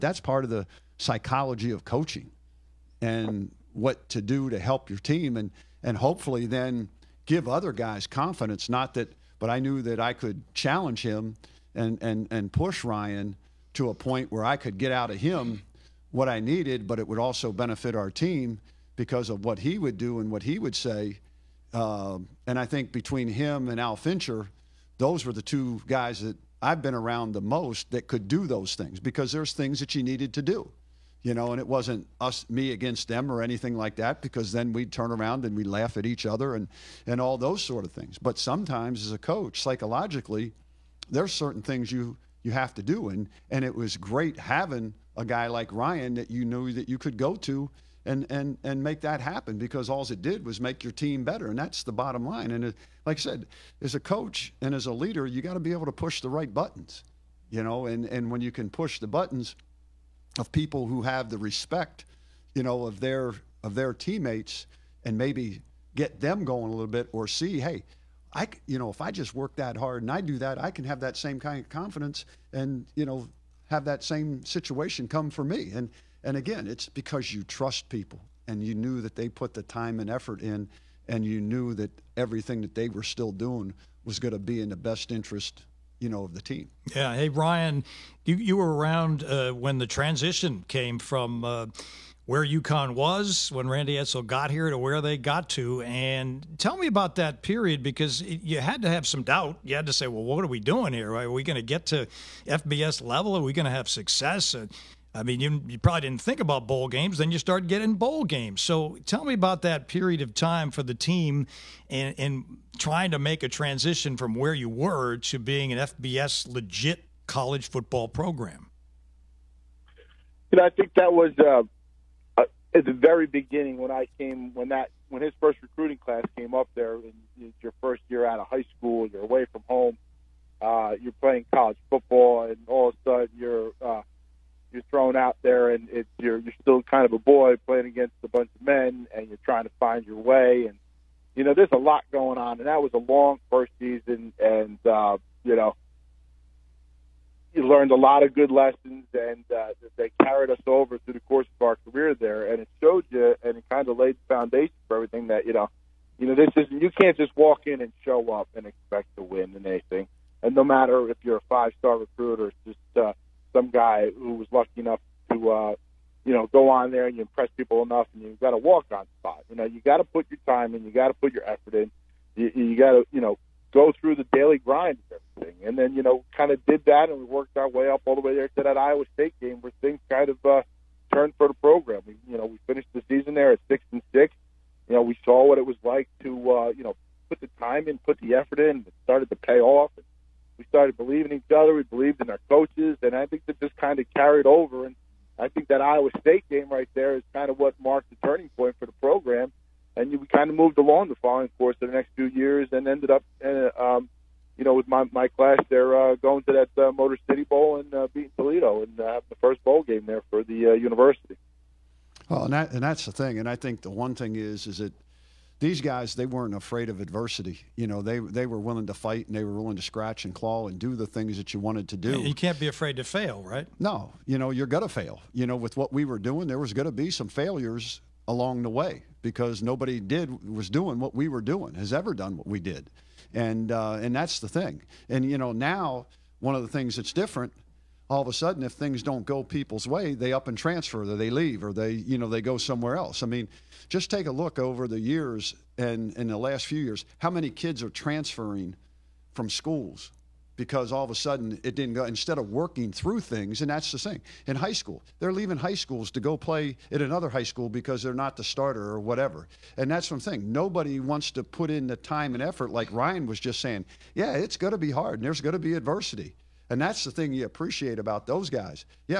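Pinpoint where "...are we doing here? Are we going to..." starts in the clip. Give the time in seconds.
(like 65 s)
100 s.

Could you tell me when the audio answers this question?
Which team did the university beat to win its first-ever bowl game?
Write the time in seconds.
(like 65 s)
208 s.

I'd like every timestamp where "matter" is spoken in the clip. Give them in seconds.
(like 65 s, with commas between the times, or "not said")
160 s.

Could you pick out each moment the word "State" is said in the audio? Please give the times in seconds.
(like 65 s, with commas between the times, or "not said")
179 s, 196 s.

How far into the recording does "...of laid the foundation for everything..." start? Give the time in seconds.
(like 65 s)
153 s.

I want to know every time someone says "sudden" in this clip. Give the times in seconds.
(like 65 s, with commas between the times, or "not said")
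133 s, 238 s, 251 s.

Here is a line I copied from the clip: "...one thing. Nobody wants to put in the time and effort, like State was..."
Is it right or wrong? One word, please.
wrong.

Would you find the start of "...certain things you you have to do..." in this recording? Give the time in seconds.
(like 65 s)
41 s.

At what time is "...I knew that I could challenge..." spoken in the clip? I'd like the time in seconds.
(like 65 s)
9 s.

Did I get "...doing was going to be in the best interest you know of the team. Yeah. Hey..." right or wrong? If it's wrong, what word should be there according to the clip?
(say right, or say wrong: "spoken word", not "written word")
right.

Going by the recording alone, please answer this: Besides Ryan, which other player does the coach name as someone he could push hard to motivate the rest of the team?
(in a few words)
Al Fincher.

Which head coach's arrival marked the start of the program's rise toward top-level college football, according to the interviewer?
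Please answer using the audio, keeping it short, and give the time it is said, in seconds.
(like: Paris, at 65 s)
Randy Edsall, at 93 s.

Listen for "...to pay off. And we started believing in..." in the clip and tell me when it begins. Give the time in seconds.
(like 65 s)
189 s.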